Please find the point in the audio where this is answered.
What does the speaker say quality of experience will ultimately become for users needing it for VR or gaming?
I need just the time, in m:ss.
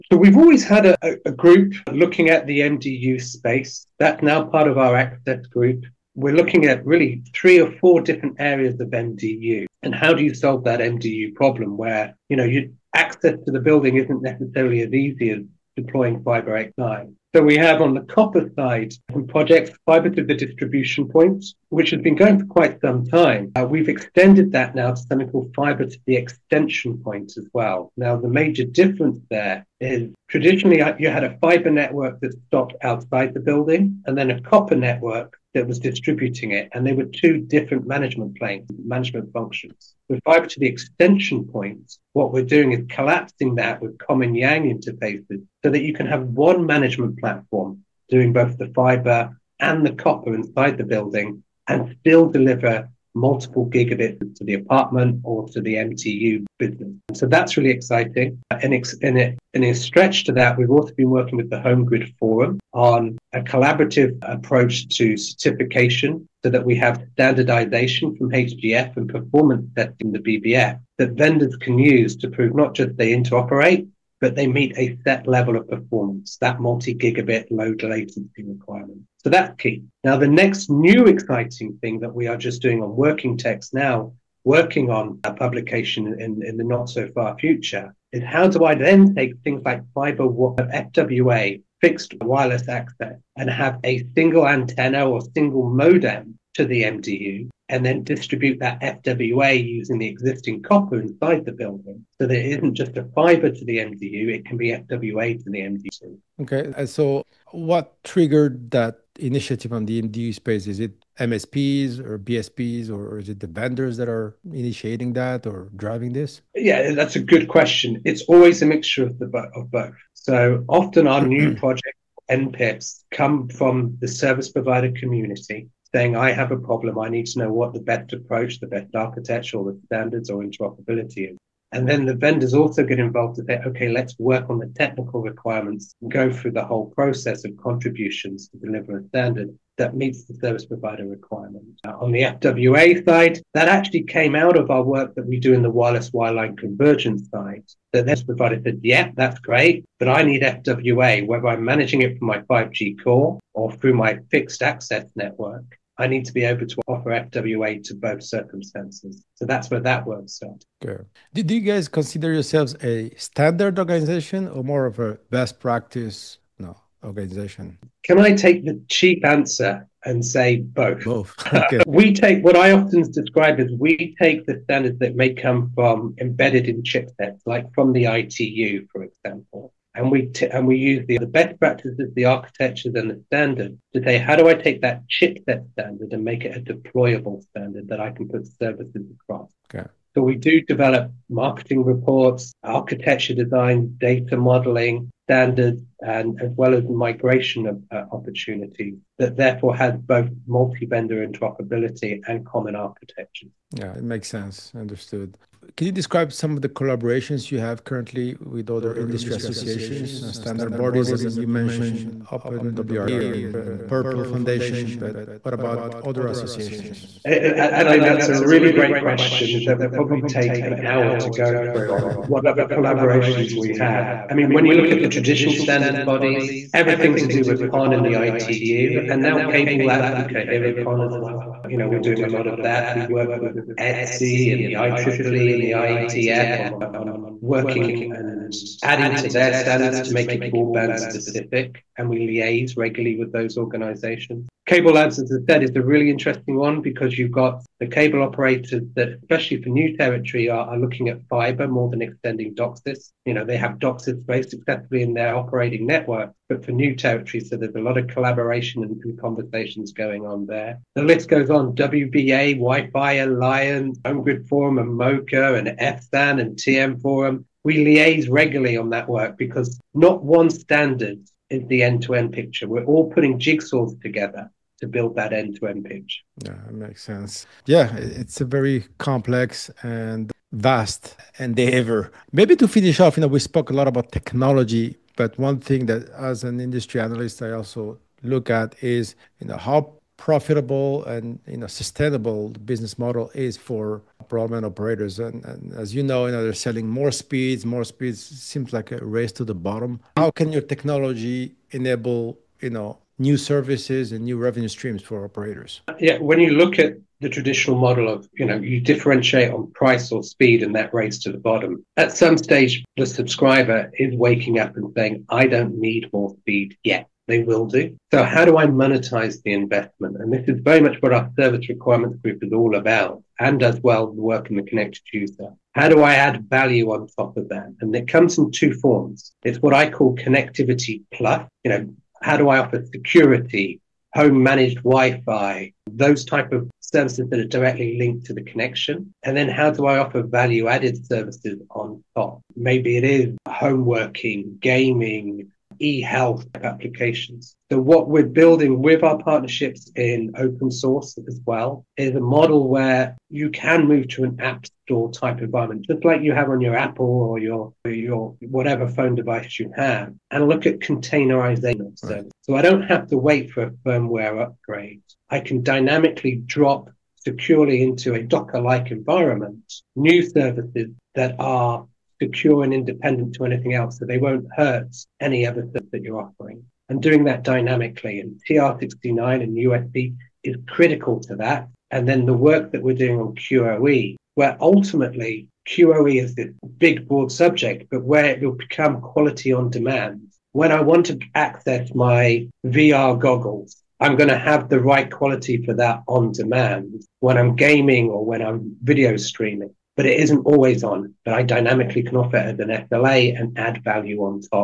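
6:29.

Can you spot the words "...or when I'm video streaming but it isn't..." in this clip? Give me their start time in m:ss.
6:38.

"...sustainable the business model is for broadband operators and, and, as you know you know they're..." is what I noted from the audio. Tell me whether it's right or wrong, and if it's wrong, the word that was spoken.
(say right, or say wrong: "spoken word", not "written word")
right.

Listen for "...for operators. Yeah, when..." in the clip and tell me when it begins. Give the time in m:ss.
5:05.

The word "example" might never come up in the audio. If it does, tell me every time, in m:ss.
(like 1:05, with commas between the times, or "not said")
2:59.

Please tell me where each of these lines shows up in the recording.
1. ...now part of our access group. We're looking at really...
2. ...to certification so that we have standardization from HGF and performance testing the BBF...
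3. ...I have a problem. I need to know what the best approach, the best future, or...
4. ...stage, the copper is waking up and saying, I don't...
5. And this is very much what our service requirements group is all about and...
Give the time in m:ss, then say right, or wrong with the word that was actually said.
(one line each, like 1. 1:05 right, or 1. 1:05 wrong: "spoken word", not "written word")
1. 0:04 right
2. 1:04 right
3. 2:06 wrong: "architecture", not "future"
4. 5:12 wrong: "subscriber", not "copper"
5. 5:20 right.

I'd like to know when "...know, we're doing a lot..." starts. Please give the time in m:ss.
3:51.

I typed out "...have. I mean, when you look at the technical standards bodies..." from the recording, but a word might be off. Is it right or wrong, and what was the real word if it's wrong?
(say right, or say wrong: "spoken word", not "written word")
wrong: "traditional", not "technical".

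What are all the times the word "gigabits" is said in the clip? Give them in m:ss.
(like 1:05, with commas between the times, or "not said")
0:53, 1:16.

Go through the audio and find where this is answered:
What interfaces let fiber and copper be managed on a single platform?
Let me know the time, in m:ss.
0:43.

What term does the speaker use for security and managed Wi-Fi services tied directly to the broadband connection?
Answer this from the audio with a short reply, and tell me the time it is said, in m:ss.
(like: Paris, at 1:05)
connectivity plus, at 5:30.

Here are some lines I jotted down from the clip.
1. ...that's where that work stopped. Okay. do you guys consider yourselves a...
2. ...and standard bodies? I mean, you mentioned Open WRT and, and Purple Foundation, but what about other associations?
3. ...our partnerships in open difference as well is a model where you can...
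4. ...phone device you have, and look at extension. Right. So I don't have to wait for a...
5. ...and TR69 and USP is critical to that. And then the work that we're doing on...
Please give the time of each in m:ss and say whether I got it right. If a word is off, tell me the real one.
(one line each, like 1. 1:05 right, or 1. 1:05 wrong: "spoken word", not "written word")
1. 2:39 wrong: "started", not "stopped"
2. 3:30 right
3. 5:49 wrong: "source", not "difference"
4. 5:58 wrong: "containerization", not "extension"
5. 6:18 right.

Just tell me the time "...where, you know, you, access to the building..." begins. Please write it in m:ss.
0:11.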